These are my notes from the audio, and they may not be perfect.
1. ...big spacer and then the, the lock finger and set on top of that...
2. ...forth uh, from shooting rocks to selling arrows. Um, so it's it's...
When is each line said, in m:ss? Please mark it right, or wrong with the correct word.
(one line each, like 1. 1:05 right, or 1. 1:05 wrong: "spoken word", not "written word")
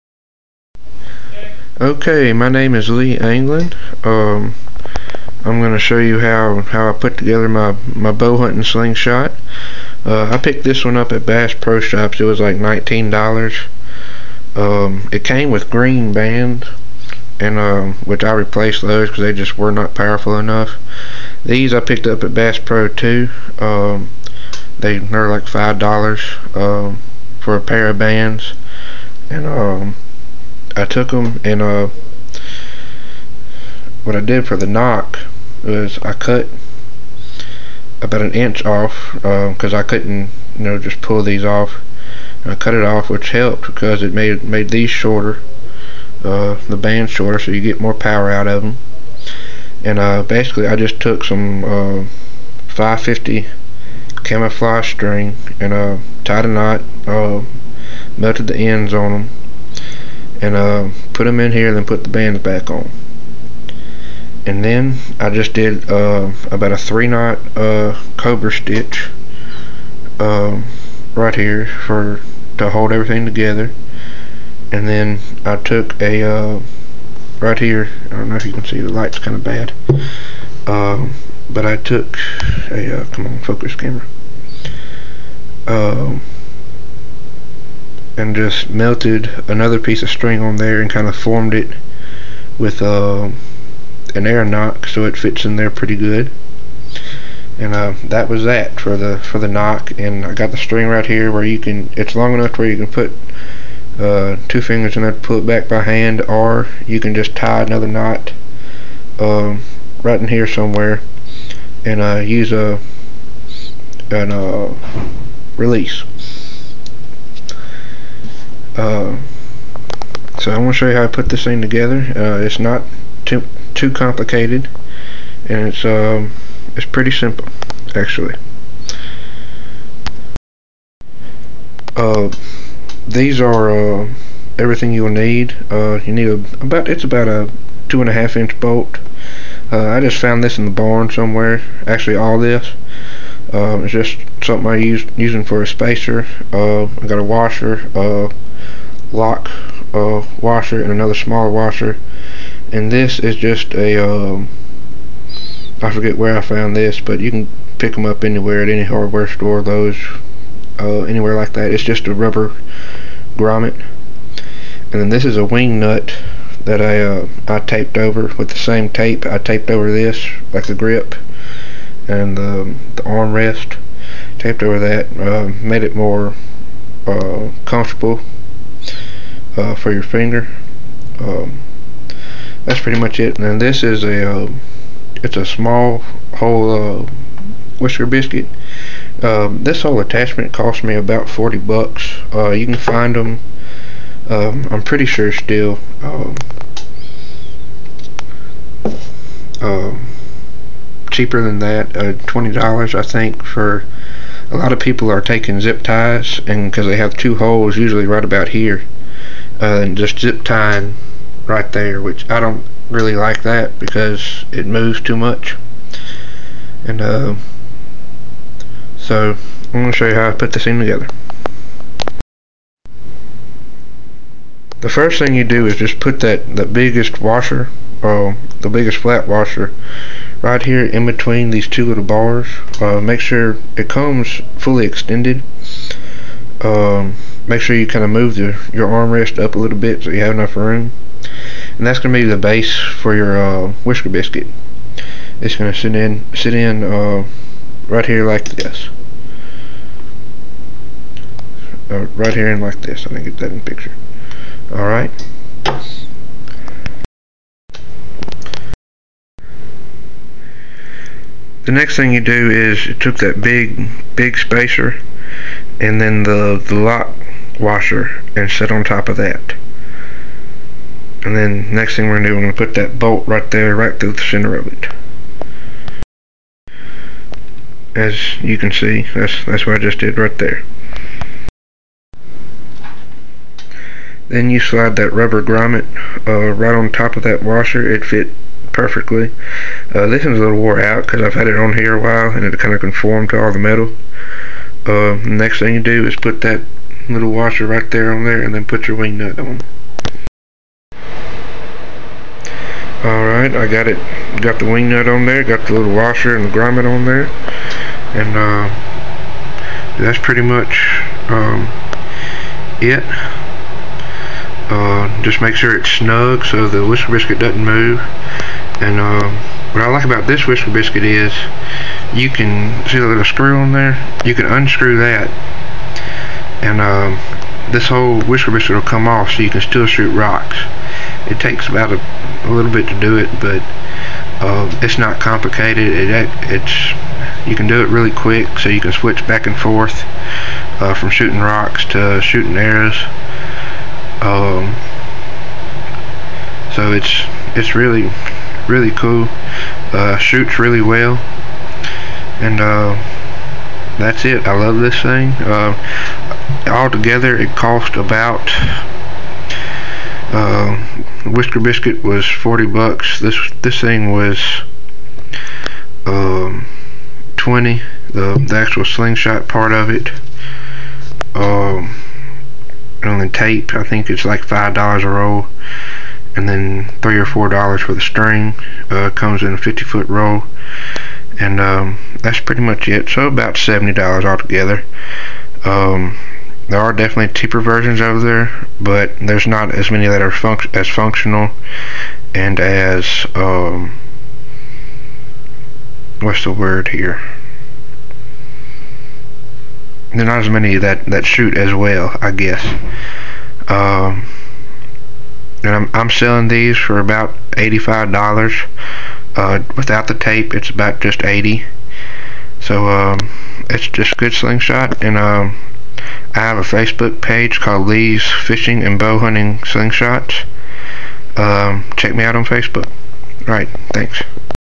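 1. 4:24 wrong: "washer", not "finger"
2. 5:39 wrong: "shooting", not "selling".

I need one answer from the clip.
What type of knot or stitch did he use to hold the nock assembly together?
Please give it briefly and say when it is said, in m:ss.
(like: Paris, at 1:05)
cobra stitch, at 1:08.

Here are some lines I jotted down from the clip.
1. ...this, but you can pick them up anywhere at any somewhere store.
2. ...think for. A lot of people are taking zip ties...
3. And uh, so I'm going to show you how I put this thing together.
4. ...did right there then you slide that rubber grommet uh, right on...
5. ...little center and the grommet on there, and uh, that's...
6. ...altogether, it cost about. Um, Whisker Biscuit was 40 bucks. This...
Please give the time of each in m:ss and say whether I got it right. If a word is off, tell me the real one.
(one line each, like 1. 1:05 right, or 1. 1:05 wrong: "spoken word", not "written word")
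1. 2:36 wrong: "hardware", not "somewhere"
2. 3:23 right
3. 3:36 right
4. 4:39 right
5. 5:05 wrong: "washer", not "center"
6. 5:56 right.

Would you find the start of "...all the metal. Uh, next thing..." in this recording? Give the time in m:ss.
4:53.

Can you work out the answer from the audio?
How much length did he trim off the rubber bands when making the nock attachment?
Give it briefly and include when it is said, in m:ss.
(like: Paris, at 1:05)
an inch, at 0:38.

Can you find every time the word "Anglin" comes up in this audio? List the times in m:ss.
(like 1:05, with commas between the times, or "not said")
0:03.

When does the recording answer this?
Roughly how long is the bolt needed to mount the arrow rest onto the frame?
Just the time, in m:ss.
2:17.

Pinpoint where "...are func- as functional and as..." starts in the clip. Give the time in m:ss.
6:30.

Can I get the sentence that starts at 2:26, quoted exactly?
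Uh, I got a washer, uh, lock uh, washer, and another smaller washer.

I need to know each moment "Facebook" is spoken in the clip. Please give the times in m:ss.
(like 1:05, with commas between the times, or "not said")
6:56, 7:02.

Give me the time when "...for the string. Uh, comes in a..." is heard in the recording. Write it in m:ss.
6:17.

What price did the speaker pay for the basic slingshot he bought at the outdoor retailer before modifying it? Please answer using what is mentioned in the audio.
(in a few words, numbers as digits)
$19.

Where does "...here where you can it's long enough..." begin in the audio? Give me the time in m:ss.
1:41.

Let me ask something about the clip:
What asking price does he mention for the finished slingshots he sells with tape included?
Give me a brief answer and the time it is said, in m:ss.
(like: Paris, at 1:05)
$85, at 6:47.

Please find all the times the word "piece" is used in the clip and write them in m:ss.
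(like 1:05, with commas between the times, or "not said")
1:29.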